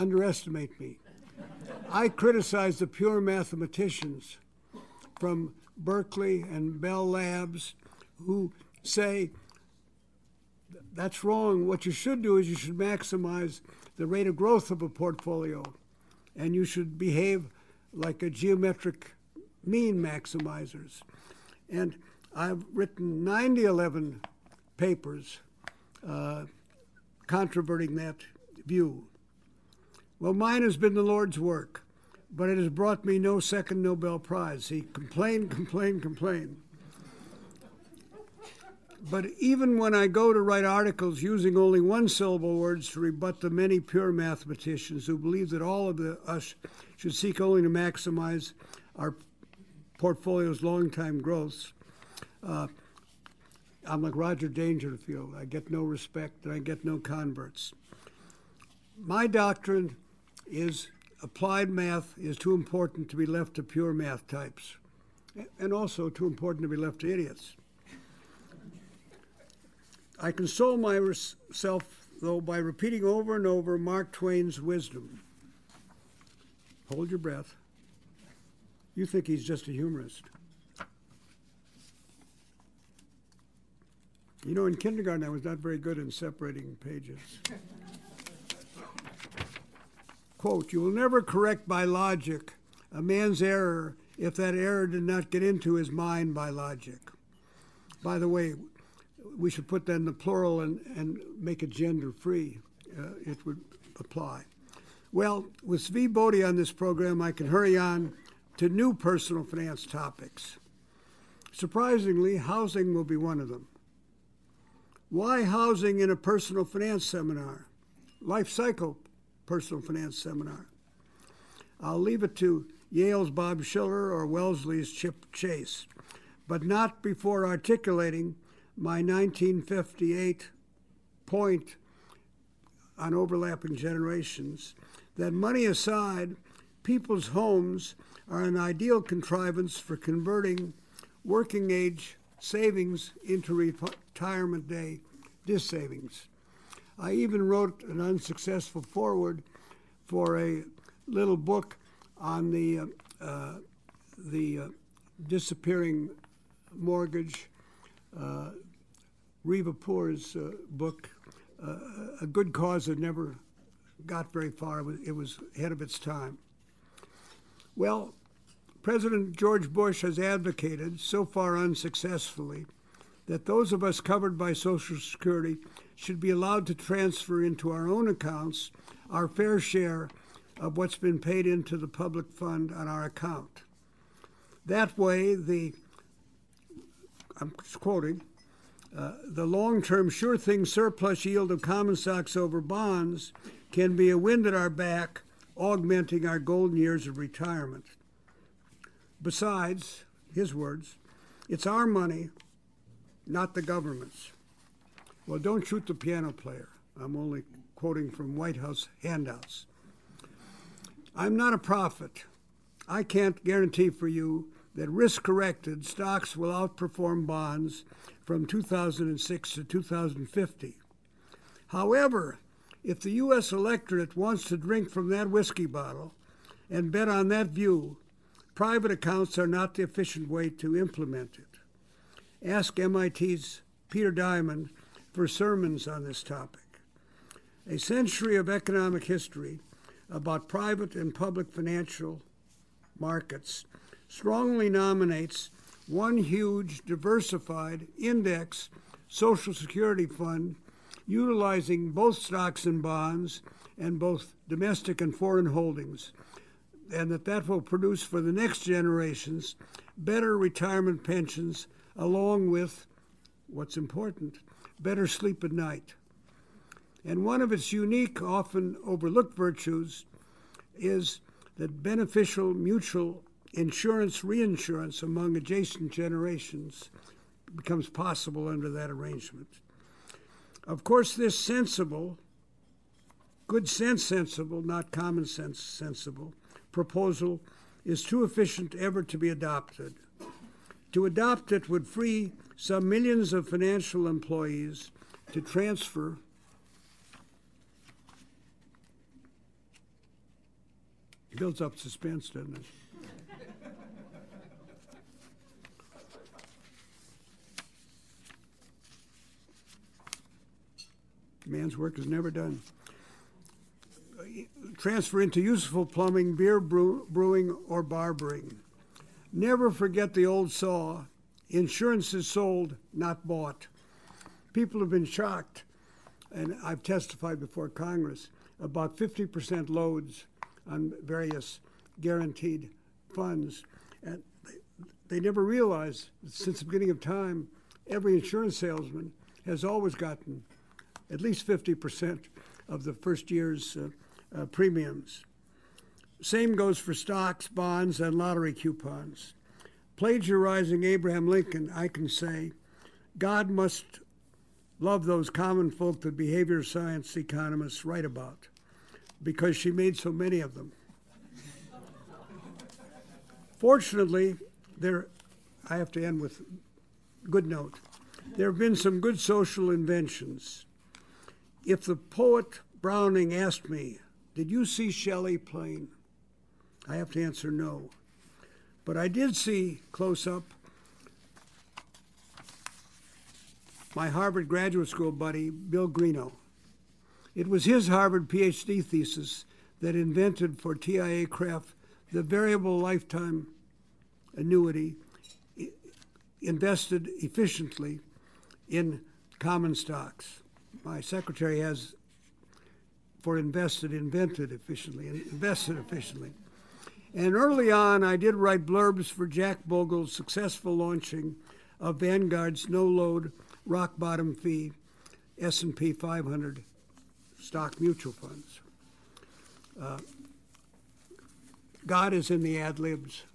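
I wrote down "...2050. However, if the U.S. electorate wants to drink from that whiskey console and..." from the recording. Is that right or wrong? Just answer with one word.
wrong.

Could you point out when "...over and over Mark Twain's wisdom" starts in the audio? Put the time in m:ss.
1:13.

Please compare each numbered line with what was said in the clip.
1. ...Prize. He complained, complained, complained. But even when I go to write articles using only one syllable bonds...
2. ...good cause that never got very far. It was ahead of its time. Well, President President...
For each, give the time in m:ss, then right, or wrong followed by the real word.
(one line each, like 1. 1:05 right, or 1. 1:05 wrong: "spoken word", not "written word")
1. 0:34 wrong: "words", not "bonds"
2. 2:42 wrong: "George", not "President".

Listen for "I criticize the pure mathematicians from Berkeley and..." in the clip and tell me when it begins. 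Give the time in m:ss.
0:01.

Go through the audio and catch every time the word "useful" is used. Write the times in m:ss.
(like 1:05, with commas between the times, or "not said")
5:15.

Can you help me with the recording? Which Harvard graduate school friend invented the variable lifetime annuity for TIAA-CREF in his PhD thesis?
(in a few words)
Bill Greenough.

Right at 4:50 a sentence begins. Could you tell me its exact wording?
To adopt it would free some millions of financial employees to transfer builds up suspense, doesn't it?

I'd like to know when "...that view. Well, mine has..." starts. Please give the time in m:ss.
0:27.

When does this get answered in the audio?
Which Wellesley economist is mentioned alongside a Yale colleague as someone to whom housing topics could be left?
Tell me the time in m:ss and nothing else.
2:04.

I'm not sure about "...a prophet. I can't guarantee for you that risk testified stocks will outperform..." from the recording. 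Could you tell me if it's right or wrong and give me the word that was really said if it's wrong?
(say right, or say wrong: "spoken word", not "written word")
wrong: "corrected", not "testified".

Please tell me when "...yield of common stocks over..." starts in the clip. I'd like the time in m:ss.
3:11.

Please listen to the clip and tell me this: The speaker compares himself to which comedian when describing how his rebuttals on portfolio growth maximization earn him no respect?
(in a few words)
Roger Dangerfield.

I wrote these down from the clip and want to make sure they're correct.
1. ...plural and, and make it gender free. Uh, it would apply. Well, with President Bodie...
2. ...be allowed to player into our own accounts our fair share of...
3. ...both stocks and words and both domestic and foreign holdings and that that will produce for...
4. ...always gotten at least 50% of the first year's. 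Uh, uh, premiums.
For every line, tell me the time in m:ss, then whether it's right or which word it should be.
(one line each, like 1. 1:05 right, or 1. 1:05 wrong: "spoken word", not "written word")
1. 1:40 wrong: "Zvi", not "President"
2. 2:56 wrong: "transfer", not "player"
3. 4:11 wrong: "bonds", not "words"
4. 5:39 right.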